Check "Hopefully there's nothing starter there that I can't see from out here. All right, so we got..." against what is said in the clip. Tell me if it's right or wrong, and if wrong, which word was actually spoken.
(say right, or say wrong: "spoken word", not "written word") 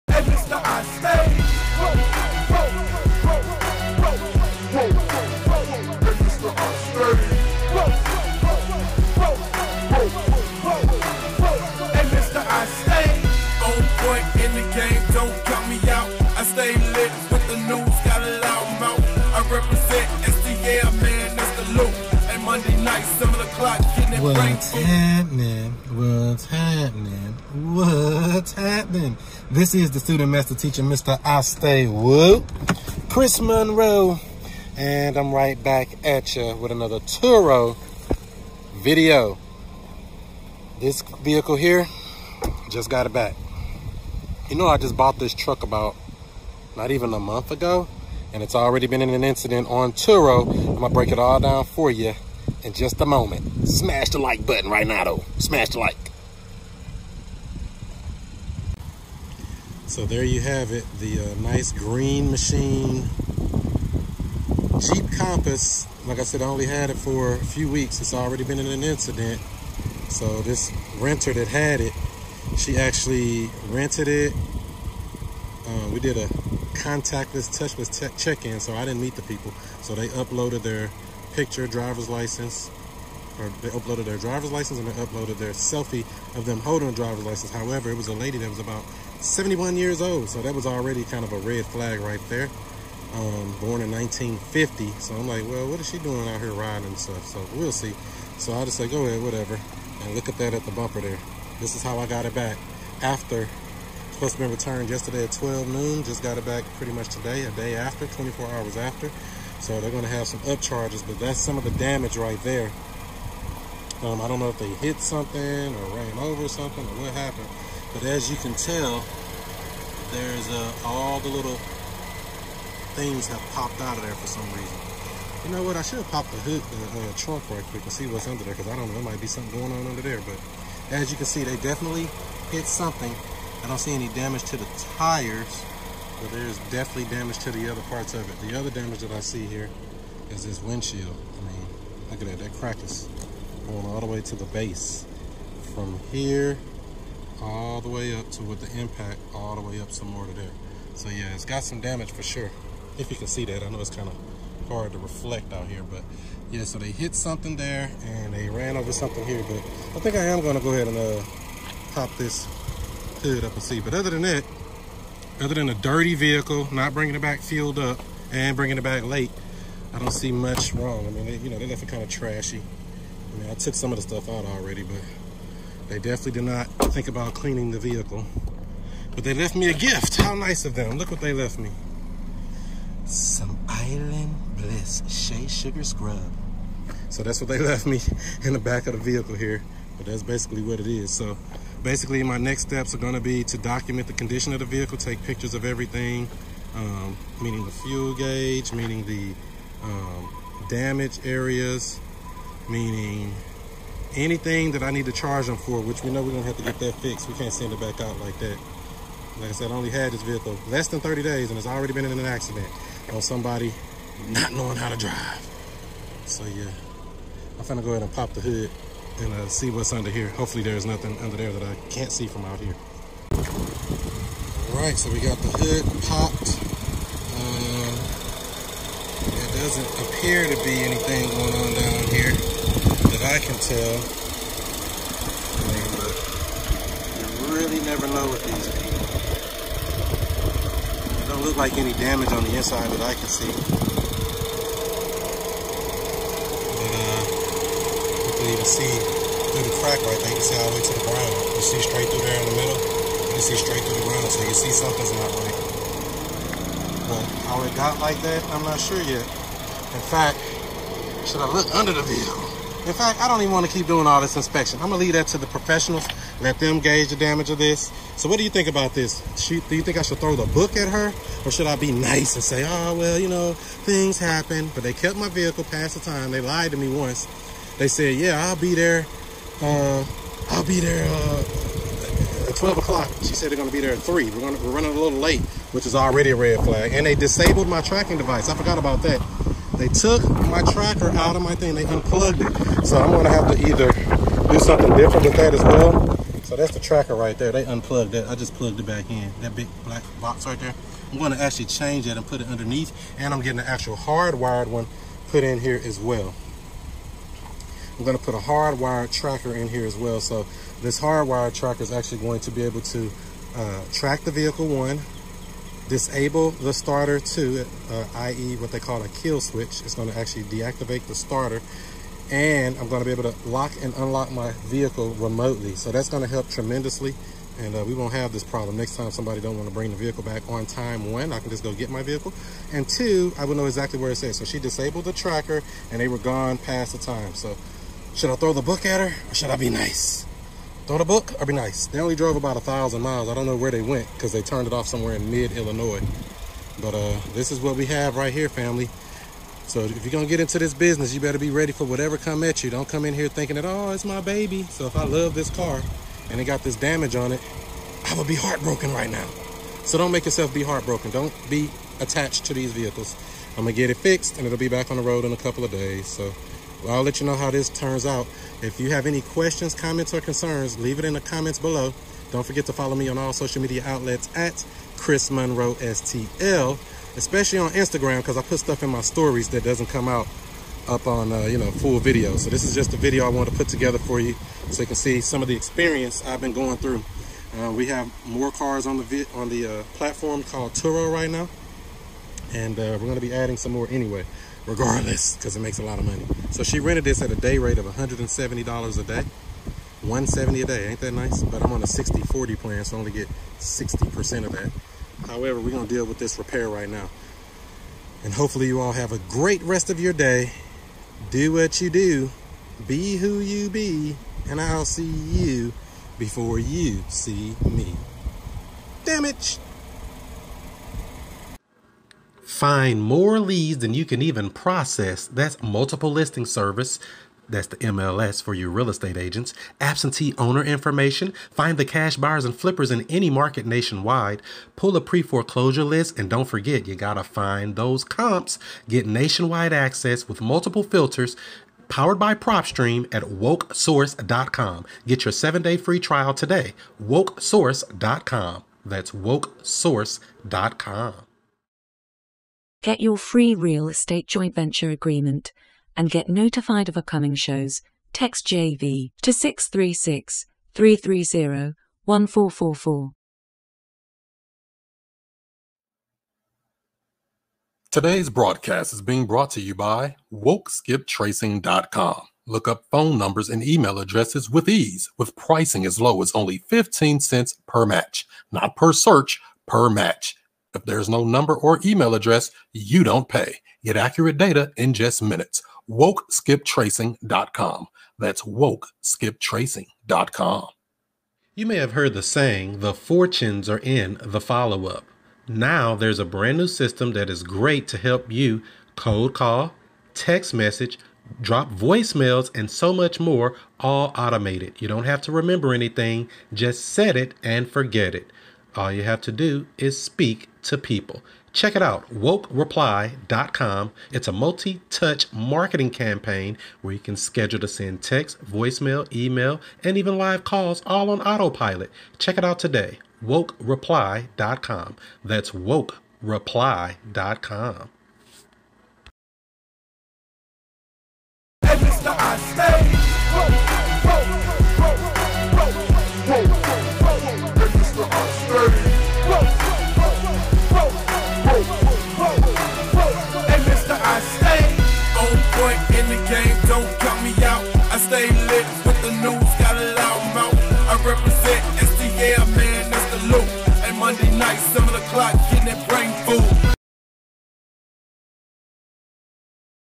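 wrong: "under", not "starter".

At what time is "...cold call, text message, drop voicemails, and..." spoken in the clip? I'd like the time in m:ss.
8:18.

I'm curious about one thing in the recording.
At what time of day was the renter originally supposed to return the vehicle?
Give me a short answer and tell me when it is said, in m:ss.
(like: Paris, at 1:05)
12 noon, at 1:45.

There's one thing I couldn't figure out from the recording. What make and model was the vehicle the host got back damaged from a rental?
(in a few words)
Jeep Compass.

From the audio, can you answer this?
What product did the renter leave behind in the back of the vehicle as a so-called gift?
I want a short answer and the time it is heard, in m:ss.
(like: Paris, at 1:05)
Island Bliss Shea Sugar Scrub, at 3:03.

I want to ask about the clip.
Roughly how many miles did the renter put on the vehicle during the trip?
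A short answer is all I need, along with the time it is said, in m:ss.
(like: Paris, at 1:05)
1000, at 5:42.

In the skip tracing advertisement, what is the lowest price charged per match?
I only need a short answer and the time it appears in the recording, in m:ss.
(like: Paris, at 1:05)
15 cents, at 7:56.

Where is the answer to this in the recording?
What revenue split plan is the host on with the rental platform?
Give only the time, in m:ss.
6:41.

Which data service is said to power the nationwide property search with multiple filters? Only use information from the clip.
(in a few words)
PropStream.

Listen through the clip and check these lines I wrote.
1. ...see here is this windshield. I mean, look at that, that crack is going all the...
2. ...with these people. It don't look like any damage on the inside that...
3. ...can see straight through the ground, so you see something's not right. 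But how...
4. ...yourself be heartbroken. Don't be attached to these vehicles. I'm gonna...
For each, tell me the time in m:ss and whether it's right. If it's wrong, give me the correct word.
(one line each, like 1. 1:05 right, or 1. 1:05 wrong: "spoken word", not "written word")
1. 2:19 right
2. 3:58 right
3. 4:13 right
4. 6:00 right.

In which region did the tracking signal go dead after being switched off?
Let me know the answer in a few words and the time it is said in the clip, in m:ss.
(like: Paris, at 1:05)
mid-Illinois, at 5:45.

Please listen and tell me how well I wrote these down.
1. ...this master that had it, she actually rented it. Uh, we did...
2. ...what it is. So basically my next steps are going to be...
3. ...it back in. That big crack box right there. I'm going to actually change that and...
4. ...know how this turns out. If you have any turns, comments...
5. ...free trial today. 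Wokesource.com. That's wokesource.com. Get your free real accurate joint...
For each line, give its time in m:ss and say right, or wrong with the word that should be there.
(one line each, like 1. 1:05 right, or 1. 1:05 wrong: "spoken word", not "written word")
1. 1:10 wrong: "renter", not "master"
2. 3:10 right
3. 4:58 wrong: "black", not "crack"
4. 6:07 wrong: "questions", not "turns"
5. 7:25 wrong: "estate", not "accurate".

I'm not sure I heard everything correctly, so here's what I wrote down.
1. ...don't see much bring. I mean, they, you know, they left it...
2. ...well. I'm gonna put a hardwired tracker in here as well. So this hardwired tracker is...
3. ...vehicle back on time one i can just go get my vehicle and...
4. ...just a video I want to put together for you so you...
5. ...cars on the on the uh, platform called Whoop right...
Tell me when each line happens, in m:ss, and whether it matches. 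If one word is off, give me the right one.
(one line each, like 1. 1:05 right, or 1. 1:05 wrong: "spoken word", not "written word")
1. 2:49 wrong: "wrong", not "bring"
2. 5:05 right
3. 5:29 right
4. 6:22 right
5. 6:28 wrong: "Turo", not "Whoop".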